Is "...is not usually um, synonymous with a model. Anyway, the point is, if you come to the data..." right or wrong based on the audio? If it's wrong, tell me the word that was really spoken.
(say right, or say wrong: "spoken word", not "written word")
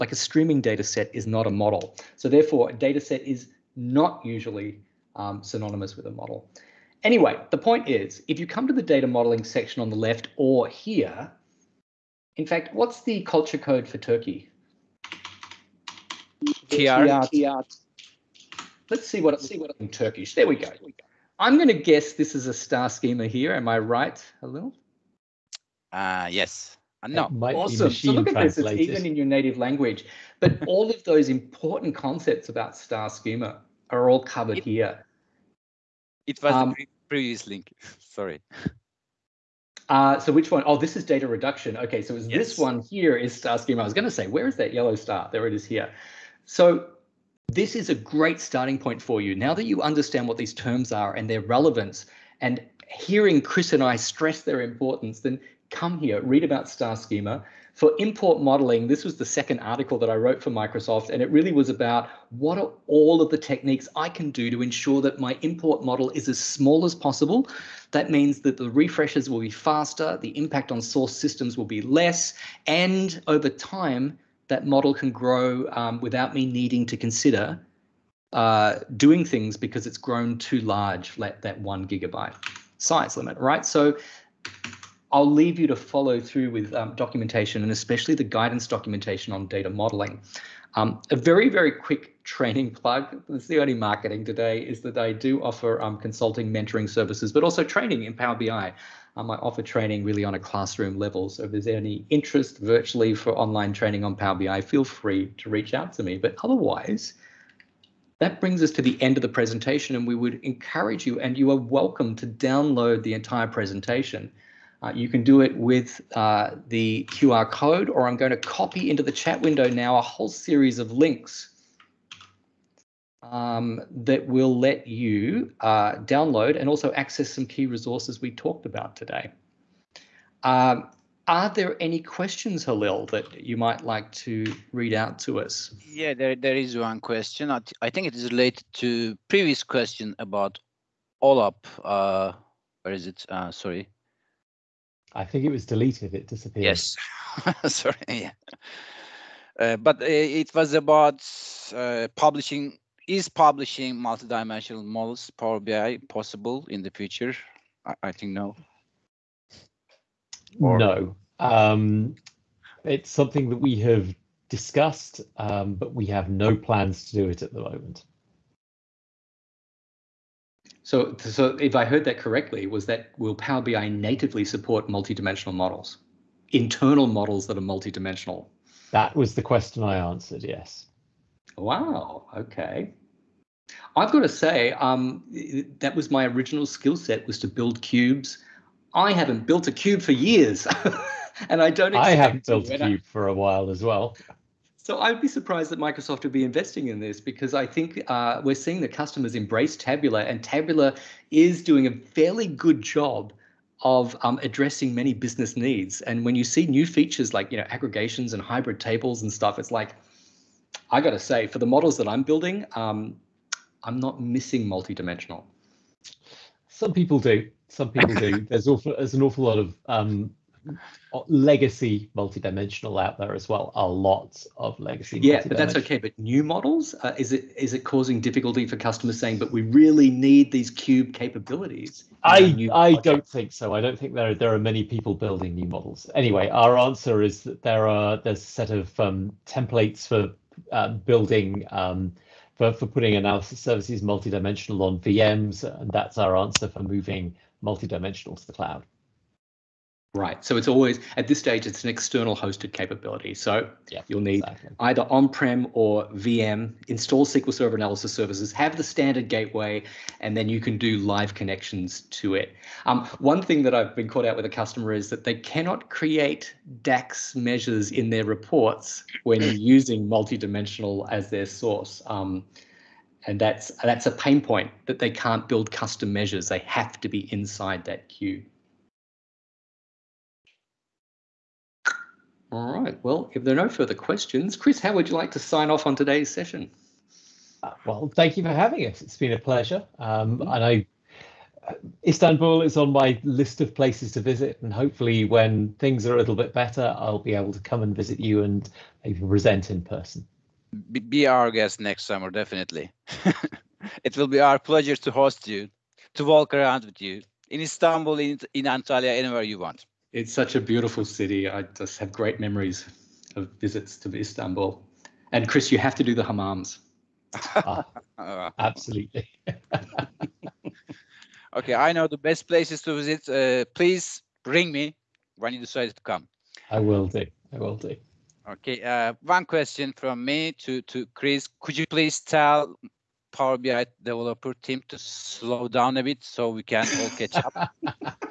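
right.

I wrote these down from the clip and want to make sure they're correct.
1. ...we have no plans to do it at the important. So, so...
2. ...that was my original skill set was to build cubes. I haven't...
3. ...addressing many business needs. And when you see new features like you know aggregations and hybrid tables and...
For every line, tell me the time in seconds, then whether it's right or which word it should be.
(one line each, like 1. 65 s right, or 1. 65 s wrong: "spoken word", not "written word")
1. 165 s wrong: "moment", not "important"
2. 185 s right
3. 204 s right.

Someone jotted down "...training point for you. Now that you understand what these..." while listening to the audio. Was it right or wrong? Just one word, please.
wrong.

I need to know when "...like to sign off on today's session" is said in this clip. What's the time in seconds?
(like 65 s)
285 s.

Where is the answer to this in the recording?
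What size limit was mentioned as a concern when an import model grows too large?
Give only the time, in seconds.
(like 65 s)
81 s.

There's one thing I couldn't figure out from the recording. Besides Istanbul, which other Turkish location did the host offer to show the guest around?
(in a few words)
Antalya.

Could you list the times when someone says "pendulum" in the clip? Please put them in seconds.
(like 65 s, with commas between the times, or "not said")
not said.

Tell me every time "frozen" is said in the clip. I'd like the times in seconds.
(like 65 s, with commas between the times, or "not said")
not said.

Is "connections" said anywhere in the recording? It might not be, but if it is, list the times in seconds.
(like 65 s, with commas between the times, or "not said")
261 s.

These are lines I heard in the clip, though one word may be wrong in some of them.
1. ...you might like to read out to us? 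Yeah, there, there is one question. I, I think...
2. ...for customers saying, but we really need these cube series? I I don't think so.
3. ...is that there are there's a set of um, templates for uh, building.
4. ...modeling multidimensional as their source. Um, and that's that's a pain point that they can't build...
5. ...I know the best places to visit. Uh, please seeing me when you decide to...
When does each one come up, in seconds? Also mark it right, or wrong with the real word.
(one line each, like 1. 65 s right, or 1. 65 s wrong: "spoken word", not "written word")
1. 133 s right
2. 228 s wrong: "capabilities", not "series"
3. 237 s right
4. 269 s wrong: "using", not "modeling"
5. 321 s wrong: "bring", not "seeing".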